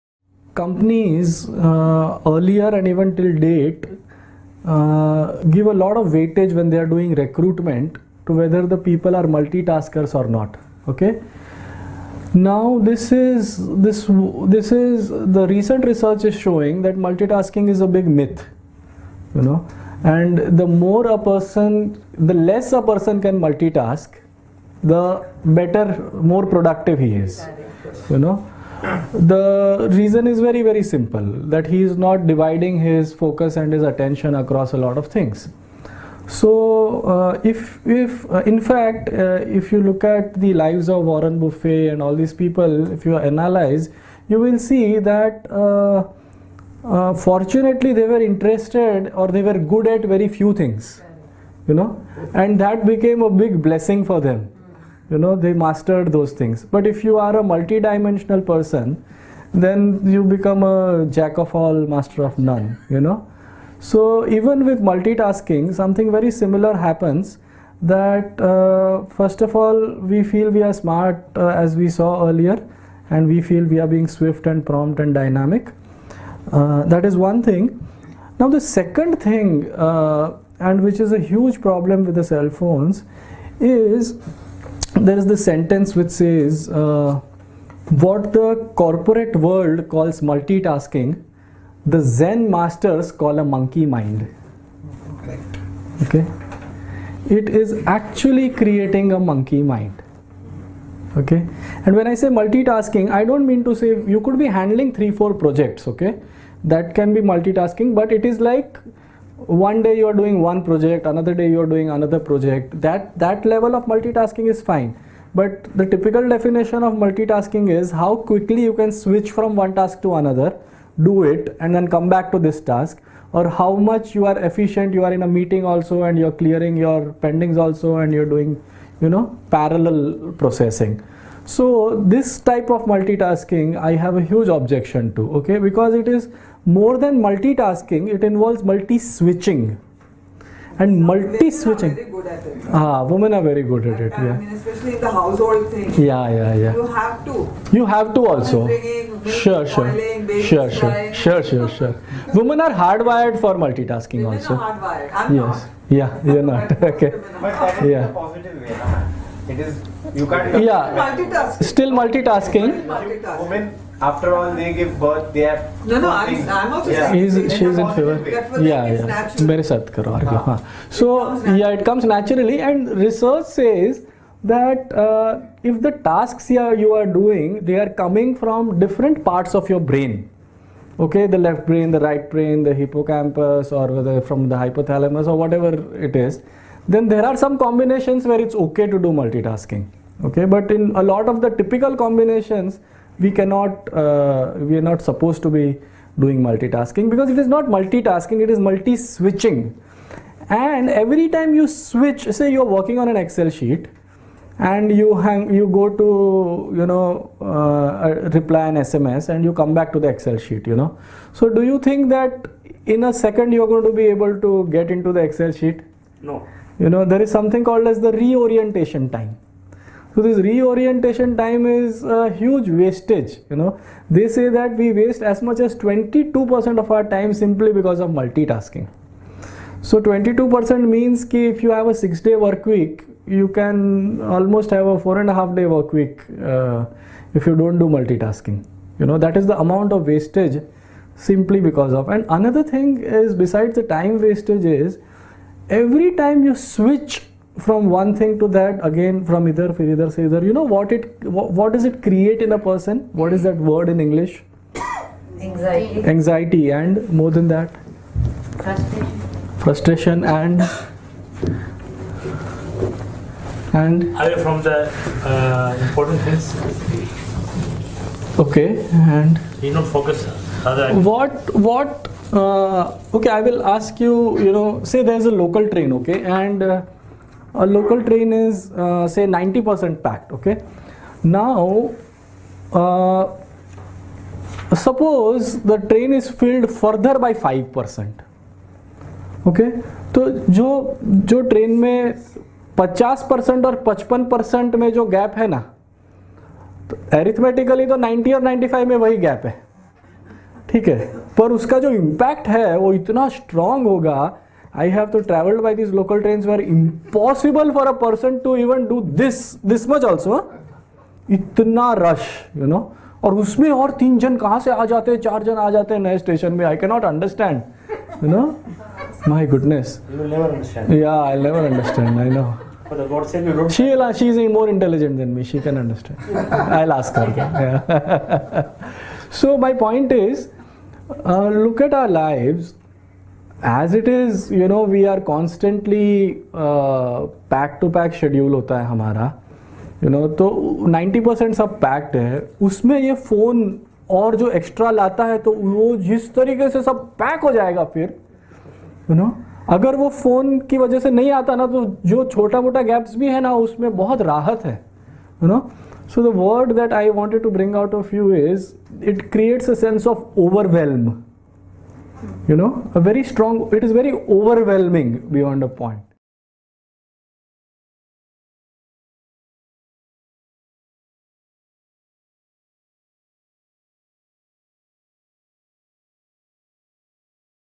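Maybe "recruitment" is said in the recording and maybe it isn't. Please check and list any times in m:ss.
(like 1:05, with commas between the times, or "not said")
0:07.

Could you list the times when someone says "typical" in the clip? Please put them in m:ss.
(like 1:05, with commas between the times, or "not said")
1:55, 3:11.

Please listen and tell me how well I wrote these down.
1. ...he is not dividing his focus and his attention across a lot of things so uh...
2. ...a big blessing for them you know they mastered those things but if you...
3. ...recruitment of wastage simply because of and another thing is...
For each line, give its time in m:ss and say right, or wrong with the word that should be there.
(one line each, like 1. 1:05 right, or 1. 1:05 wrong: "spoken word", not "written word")
1. 0:31 right
2. 0:53 right
3. 3:59 wrong: "amount", not "recruitment".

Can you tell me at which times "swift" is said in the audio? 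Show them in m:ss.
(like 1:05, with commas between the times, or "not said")
1:14.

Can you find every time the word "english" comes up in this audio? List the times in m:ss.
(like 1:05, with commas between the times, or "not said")
4:14.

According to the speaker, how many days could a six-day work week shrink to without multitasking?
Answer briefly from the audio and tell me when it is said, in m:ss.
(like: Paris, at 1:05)
4.5 days, at 3:55.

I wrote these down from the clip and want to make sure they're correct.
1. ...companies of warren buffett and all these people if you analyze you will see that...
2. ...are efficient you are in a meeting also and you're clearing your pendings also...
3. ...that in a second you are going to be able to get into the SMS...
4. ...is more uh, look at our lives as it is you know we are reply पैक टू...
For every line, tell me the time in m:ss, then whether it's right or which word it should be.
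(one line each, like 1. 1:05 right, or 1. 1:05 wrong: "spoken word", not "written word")
1. 0:40 wrong: "lives", not "companies"
2. 2:04 right
3. 3:32 wrong: "Excel", not "SMS"
4. 5:24 wrong: "constantly", not "reply".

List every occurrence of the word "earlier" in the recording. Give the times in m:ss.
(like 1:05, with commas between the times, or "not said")
0:02, 1:12.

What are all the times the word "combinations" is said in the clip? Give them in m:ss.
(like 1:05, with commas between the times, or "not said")
3:07, 3:11.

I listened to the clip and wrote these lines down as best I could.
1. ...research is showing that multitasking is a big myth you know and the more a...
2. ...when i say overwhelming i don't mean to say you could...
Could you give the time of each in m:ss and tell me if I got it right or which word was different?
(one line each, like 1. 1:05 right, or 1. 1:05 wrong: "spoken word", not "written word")
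1. 0:15 right
2. 1:41 wrong: "multitasking", not "overwhelming".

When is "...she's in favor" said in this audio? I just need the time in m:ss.
2:47.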